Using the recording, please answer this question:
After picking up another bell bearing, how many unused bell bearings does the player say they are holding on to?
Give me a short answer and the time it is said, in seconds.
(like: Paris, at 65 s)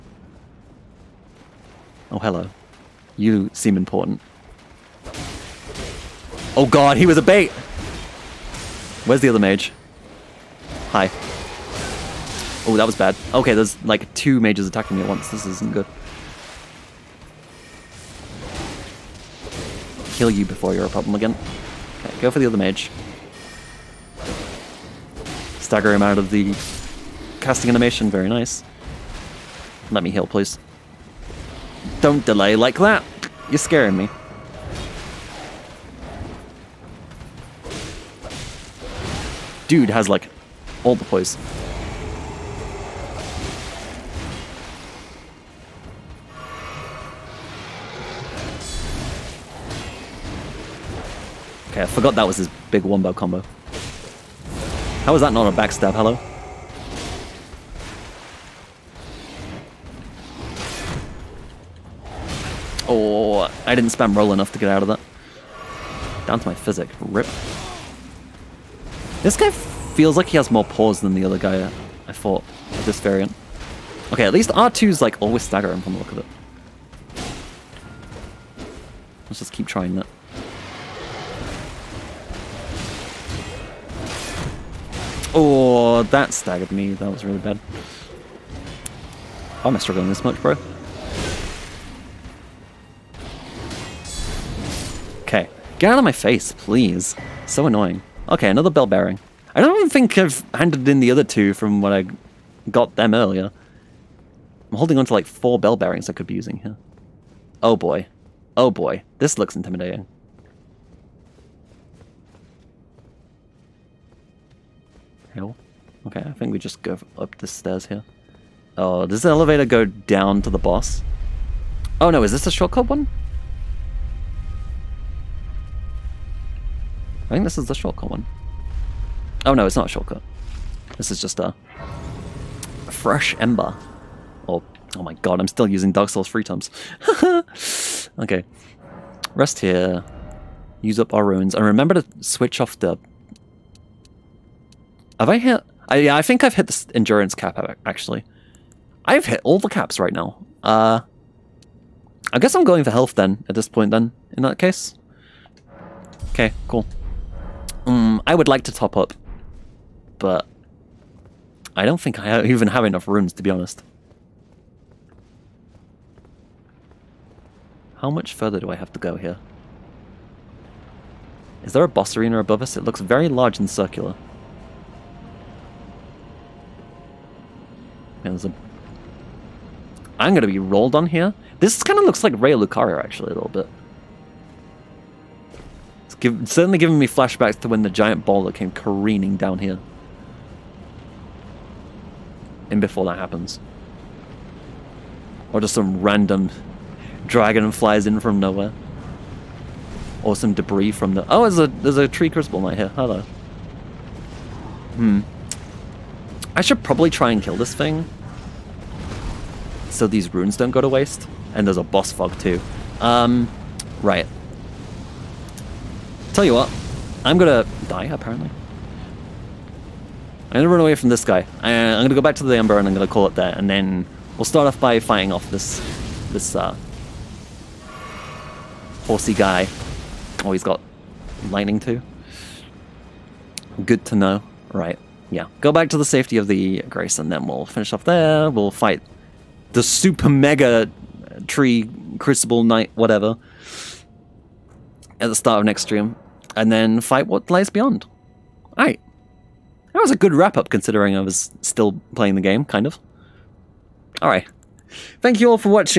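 4, at 105 s.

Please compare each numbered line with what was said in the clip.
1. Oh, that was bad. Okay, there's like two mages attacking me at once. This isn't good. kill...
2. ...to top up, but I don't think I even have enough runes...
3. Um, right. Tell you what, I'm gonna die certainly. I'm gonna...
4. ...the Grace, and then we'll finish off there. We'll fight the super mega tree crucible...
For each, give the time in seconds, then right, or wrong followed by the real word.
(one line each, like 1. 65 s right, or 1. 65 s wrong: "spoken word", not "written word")
1. 12 s right
2. 158 s right
3. 212 s wrong: "apparently", not "certainly"
4. 236 s right.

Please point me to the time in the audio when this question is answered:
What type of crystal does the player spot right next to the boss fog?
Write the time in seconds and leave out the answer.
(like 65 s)
202 s.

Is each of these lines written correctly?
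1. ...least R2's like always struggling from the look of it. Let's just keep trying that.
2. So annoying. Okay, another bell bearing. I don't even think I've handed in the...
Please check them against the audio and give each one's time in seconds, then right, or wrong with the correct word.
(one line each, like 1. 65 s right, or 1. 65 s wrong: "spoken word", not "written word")
1. 74 s wrong: "staggering", not "struggling"
2. 97 s right.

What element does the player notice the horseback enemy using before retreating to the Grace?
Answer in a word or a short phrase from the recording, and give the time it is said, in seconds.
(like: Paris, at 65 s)
Lightning, at 231 s.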